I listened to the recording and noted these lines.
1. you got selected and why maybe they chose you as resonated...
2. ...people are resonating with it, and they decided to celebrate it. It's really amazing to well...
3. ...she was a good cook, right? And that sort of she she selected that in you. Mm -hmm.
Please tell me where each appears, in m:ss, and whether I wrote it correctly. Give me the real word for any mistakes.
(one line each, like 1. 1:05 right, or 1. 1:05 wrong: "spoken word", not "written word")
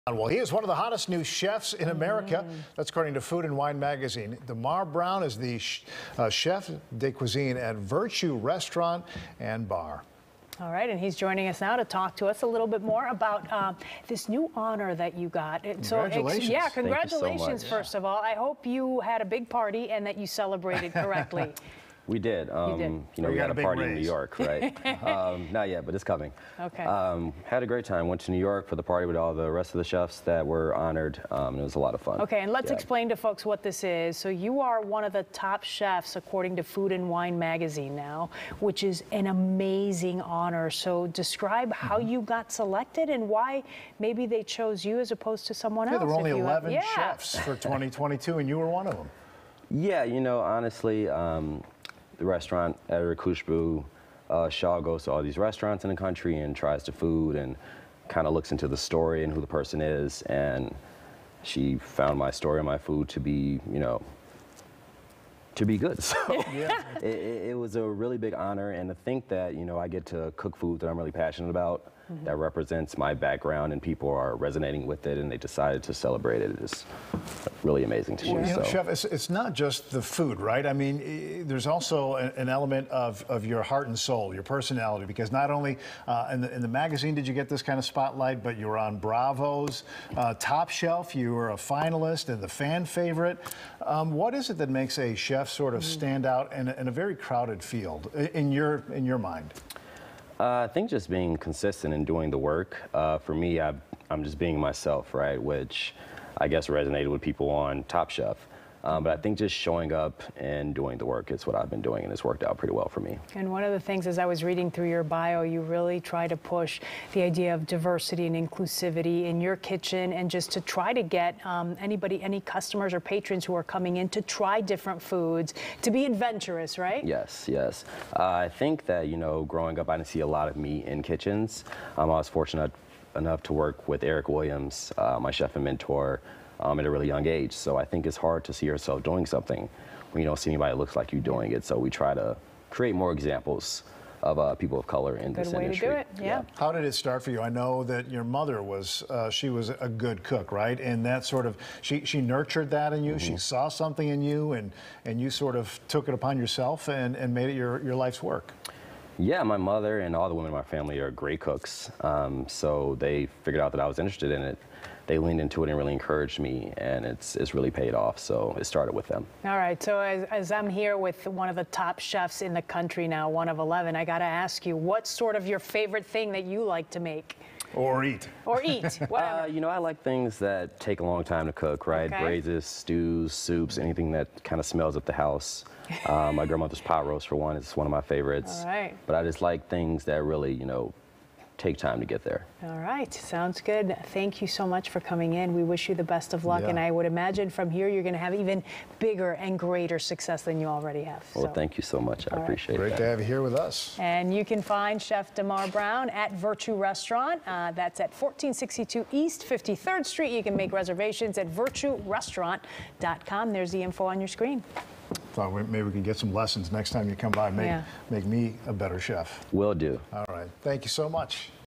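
1. 0:42 wrong: "opposed", not "resonated"
2. 1:13 right
3. 2:29 wrong: "nurtured", not "selected".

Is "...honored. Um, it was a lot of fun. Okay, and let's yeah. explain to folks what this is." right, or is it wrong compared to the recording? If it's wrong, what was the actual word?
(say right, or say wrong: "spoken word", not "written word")
right.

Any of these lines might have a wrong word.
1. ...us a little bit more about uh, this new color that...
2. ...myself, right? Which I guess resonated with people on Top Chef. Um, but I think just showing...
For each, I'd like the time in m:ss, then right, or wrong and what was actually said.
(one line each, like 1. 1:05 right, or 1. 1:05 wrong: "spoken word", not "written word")
1. 0:12 wrong: "honor", not "color"
2. 1:44 right.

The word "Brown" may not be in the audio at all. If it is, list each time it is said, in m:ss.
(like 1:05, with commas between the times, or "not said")
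0:04, 3:25.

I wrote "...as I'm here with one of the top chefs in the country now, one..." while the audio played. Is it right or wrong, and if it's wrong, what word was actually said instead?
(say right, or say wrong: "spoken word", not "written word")
right.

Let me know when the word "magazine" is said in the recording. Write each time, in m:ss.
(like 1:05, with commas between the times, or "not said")
0:03, 0:37, 1:26.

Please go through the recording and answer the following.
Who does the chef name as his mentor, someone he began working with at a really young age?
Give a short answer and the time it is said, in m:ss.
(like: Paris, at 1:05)
Erick Williams, at 2:14.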